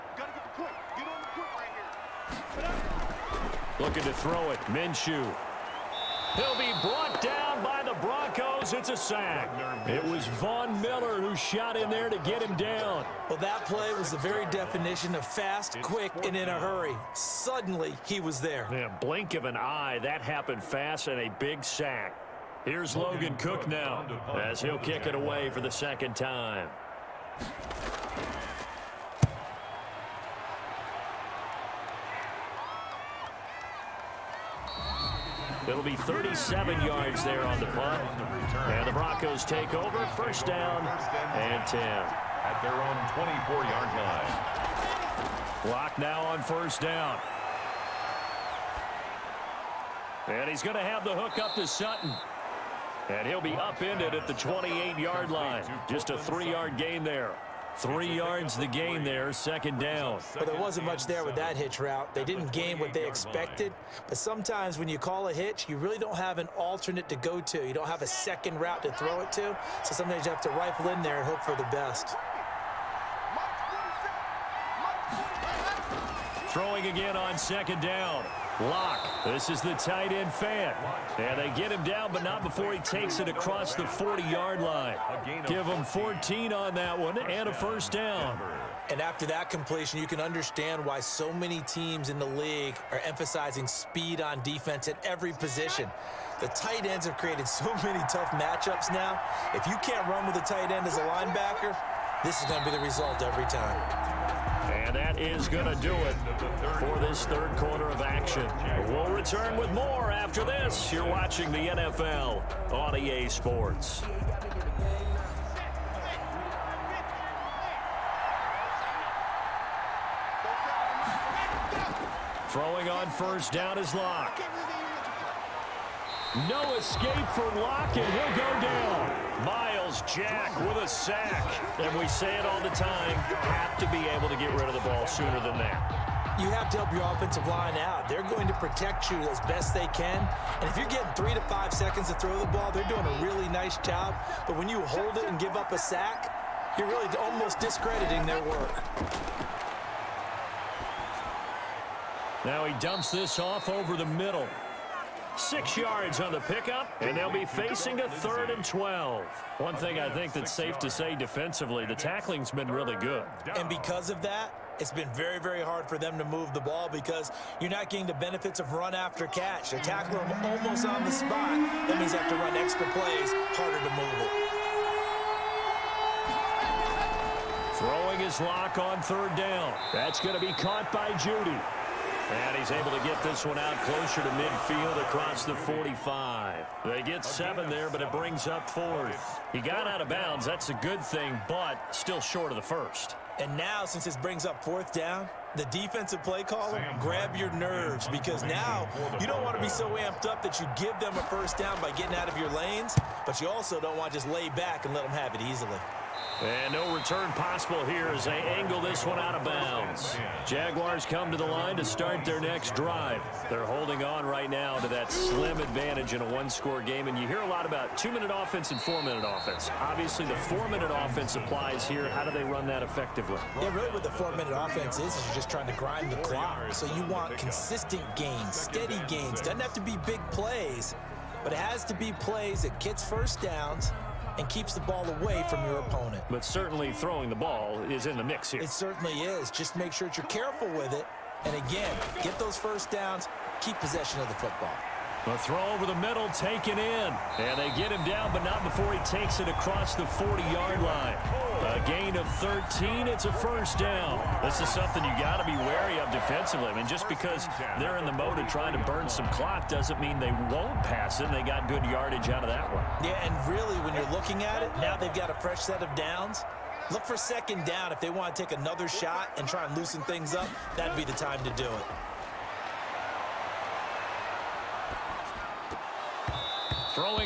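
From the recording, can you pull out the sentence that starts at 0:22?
Here's Logan Cooke now as he'll kick it away for the second time.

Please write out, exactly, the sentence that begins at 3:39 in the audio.
Obviously, the four-minute offense applies here.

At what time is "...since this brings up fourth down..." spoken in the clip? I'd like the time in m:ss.
3:13.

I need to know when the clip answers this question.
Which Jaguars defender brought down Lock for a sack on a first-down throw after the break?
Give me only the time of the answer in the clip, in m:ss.
2:09.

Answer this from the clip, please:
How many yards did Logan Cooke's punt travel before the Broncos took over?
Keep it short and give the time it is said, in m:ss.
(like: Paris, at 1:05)
37, at 0:35.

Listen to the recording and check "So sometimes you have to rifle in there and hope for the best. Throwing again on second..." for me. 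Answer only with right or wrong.
right.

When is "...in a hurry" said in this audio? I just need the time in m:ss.
0:16.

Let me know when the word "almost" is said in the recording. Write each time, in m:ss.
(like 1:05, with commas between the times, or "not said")
2:27, 2:50.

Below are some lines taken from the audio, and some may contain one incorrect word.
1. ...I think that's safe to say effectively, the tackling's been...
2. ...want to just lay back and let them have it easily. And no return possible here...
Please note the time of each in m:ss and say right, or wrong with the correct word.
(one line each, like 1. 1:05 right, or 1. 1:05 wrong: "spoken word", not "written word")
1. 2:39 wrong: "defensively", not "effectively"
2. 3:23 right.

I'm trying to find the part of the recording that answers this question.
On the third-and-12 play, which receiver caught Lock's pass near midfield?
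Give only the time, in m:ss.
3:01.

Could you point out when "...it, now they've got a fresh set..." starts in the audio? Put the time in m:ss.
4:24.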